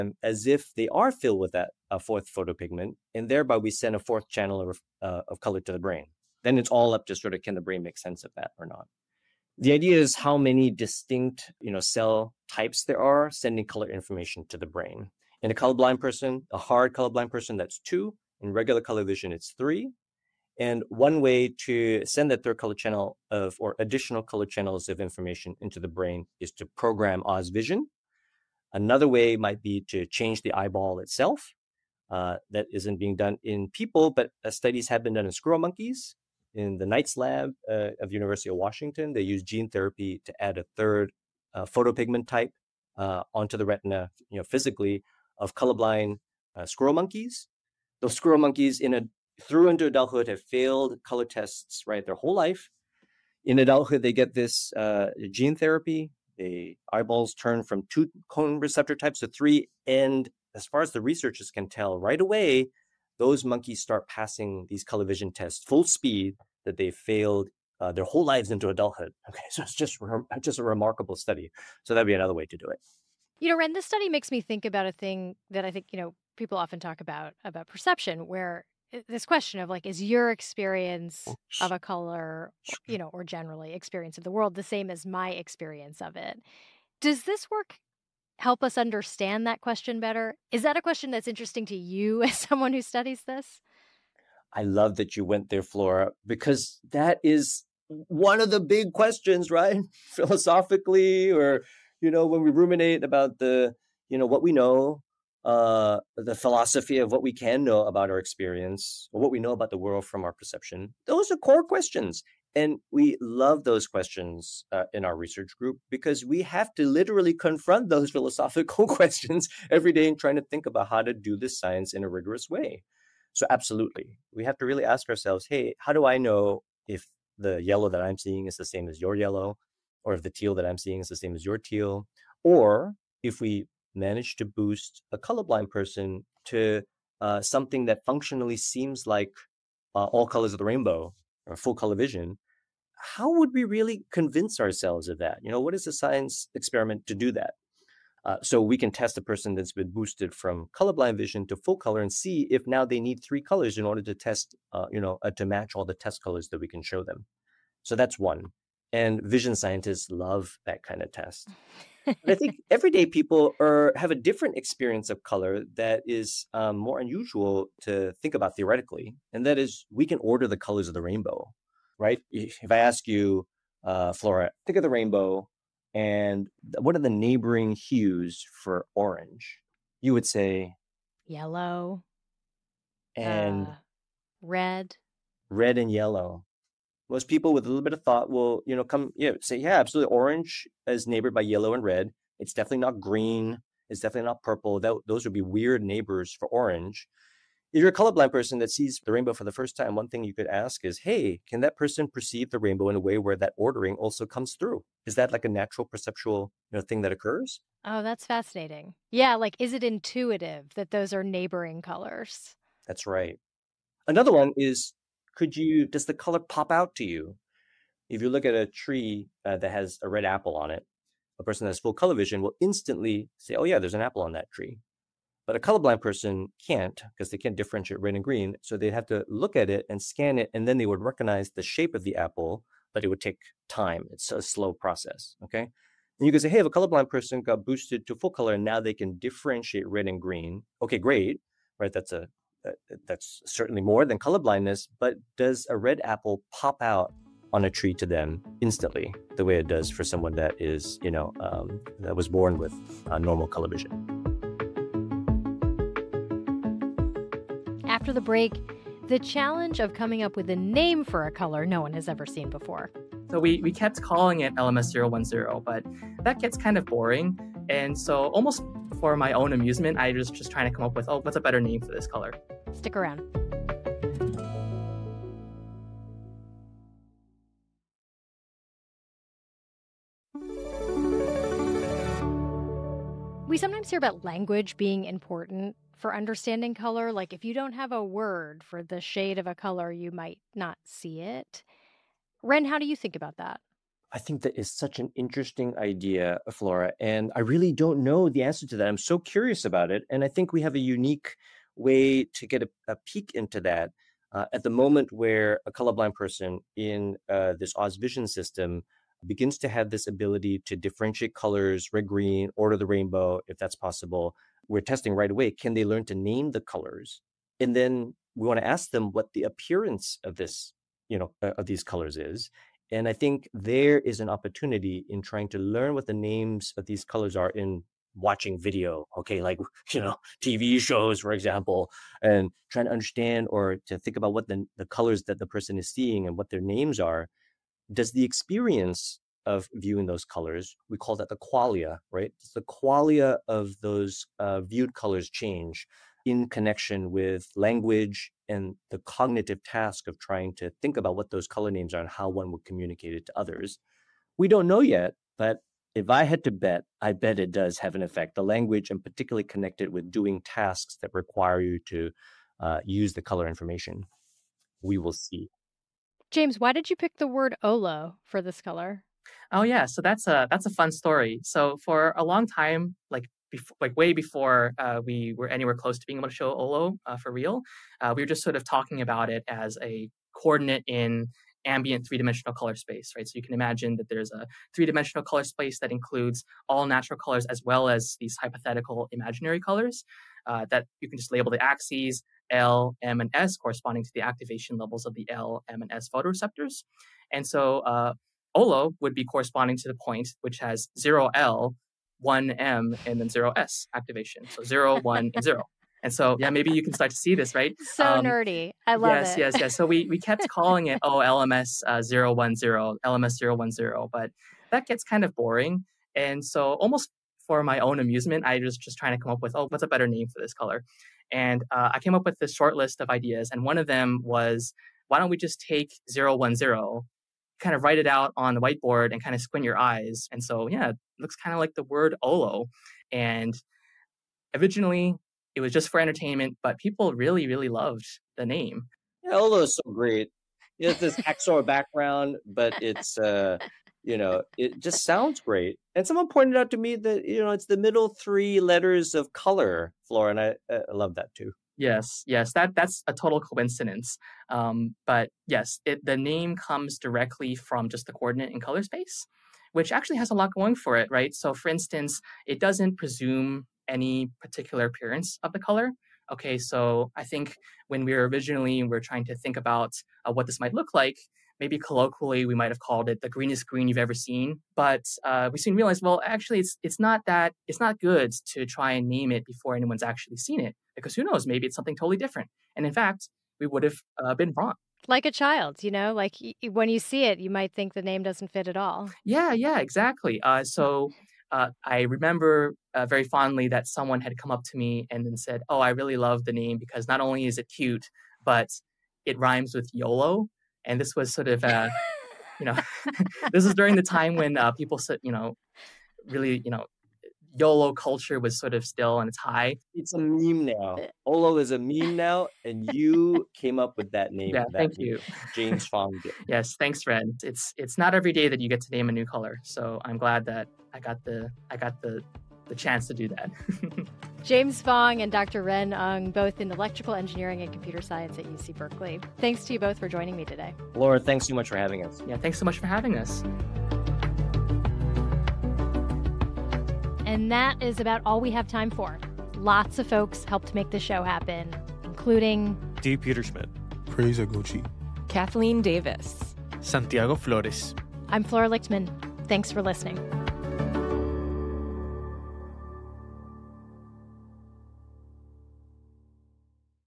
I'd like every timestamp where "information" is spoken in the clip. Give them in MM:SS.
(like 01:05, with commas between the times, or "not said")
00:13, 00:24, 06:03.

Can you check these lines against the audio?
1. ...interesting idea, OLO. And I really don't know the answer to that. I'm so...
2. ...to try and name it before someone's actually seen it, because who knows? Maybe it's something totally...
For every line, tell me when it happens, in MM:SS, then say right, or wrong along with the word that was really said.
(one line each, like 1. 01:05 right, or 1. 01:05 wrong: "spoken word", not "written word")
1. 04:55 wrong: "Flora", not "OLO"
2. 07:58 wrong: "anyone", not "someone".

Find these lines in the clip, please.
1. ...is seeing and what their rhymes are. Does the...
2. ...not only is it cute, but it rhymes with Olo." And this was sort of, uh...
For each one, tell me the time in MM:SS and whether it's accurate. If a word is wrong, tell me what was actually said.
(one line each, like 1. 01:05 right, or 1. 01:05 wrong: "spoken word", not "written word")
1. 05:35 wrong: "names", not "rhymes"
2. 08:17 wrong: "YOLO", not "Olo".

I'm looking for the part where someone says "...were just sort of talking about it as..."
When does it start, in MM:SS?
06:18.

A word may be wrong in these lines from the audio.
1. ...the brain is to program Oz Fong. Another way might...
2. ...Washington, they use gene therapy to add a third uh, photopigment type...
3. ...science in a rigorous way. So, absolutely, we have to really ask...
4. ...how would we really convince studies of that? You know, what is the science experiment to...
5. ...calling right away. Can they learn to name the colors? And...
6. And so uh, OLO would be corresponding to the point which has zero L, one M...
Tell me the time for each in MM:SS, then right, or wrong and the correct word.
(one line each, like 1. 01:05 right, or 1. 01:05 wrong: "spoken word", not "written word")
1. 00:25 wrong: "Vision", not "Fong"
2. 00:38 right
3. 02:01 right
4. 02:22 wrong: "ourselves", not "studies"
5. 05:14 wrong: "testing", not "calling"
6. 06:37 right.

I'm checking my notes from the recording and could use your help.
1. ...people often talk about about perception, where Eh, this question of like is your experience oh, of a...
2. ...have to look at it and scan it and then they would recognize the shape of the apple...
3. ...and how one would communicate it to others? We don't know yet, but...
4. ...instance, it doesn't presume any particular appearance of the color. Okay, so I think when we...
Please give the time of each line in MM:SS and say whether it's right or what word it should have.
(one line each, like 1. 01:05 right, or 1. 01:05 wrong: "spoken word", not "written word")
1. 01:16 right
2. 03:48 right
3. 05:52 right
4. 07:41 right.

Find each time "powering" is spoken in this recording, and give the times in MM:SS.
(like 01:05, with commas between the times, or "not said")
not said.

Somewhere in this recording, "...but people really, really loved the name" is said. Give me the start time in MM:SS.
07:16.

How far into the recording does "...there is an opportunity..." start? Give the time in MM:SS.
05:23.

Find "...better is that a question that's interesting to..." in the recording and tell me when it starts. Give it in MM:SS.
01:30.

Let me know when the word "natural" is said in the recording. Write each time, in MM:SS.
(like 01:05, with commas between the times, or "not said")
03:25, 06:26.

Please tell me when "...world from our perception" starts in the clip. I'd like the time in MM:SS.
01:49.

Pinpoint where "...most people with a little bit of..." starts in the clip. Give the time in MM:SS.
03:07.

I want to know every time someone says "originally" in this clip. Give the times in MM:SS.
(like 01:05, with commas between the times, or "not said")
07:14, 07:48.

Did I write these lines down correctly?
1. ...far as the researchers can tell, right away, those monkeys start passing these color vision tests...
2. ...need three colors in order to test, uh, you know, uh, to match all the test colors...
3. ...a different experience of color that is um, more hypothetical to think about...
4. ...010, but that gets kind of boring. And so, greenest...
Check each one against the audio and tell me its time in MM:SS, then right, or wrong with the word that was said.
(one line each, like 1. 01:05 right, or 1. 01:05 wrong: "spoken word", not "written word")
1. 01:00 right
2. 02:33 right
3. 02:44 wrong: "unusual", not "hypothetical"
4. 06:53 wrong: "almost", not "greenest".